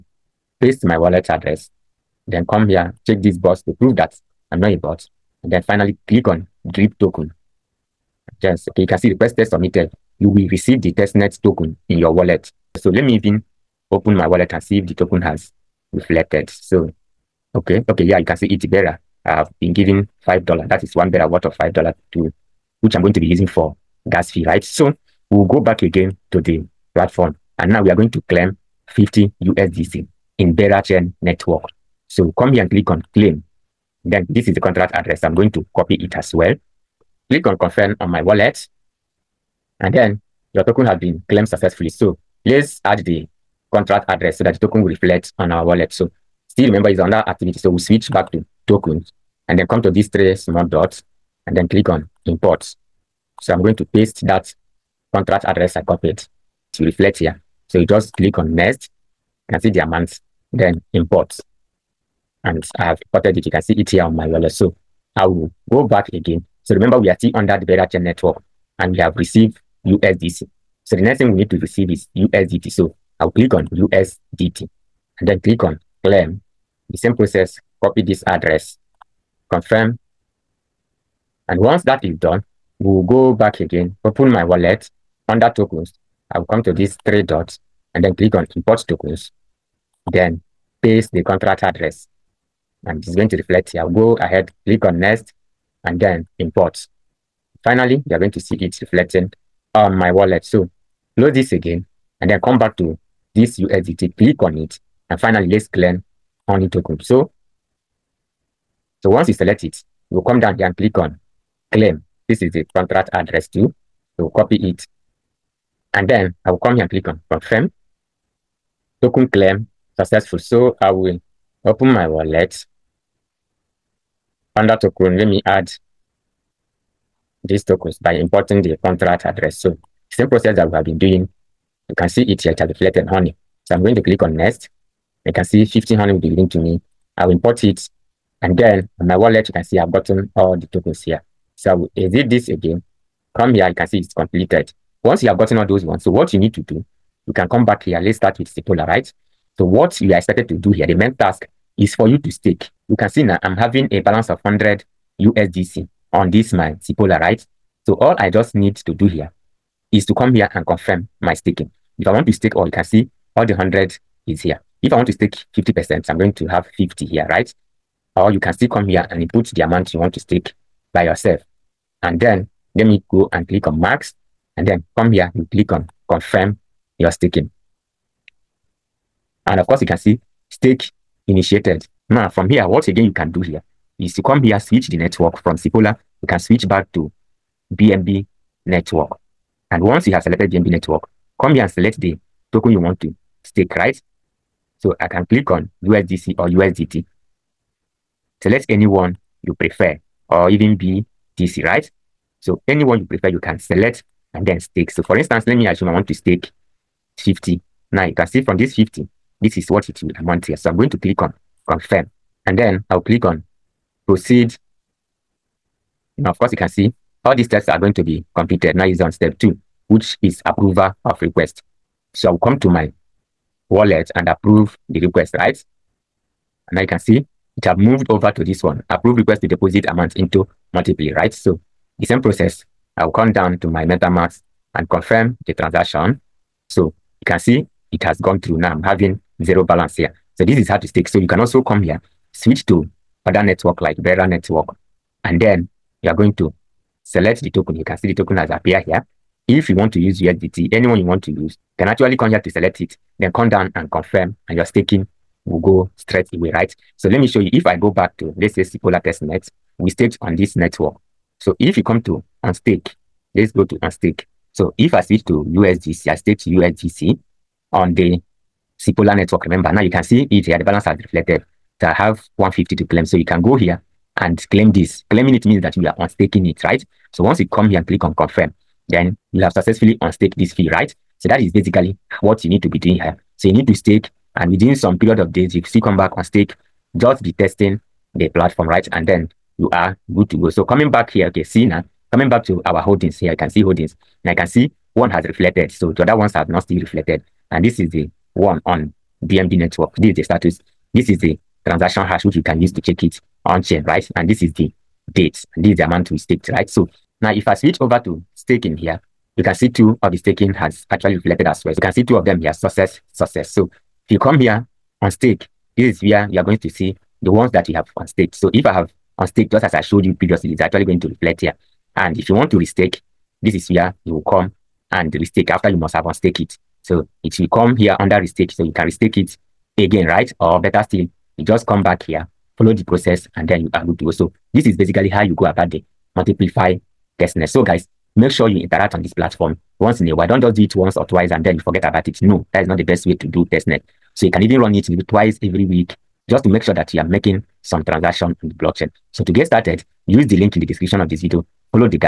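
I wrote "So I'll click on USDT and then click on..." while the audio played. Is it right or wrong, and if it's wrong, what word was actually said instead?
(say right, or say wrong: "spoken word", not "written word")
right.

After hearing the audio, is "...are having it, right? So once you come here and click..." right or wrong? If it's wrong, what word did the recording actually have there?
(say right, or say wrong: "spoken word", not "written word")
wrong: "unstaking", not "having".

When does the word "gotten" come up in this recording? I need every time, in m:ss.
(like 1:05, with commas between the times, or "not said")
2:19, 2:25.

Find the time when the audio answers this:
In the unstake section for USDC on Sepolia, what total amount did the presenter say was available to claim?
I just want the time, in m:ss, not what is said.
4:32.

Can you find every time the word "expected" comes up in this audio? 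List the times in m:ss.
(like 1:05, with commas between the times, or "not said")
2:30.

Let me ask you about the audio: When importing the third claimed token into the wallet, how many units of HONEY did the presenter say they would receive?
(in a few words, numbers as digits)
15.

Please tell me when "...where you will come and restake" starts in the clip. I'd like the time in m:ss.
5:23.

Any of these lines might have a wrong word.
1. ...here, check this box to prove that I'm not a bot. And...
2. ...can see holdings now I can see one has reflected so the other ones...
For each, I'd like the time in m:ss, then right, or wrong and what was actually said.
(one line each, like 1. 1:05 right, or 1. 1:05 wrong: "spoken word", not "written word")
1. 0:02 right
2. 4:53 right.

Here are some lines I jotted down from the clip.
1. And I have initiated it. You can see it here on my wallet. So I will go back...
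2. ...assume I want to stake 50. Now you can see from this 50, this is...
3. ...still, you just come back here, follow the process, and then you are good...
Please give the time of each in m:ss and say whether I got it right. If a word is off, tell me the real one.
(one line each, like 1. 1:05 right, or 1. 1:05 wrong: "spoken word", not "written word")
1. 1:02 wrong: "imported", not "initiated"
2. 3:25 right
3. 5:30 right.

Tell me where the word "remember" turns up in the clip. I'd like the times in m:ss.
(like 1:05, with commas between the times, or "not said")
0:46, 1:06, 4:29.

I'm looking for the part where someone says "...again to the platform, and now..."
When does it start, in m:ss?
0:25.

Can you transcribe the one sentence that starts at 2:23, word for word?
Come here, you can see it's completed.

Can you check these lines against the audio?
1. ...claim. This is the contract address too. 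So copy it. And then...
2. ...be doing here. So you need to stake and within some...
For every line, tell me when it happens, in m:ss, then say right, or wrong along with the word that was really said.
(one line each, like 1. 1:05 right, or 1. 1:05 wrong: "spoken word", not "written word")
1. 1:51 right
2. 4:42 right.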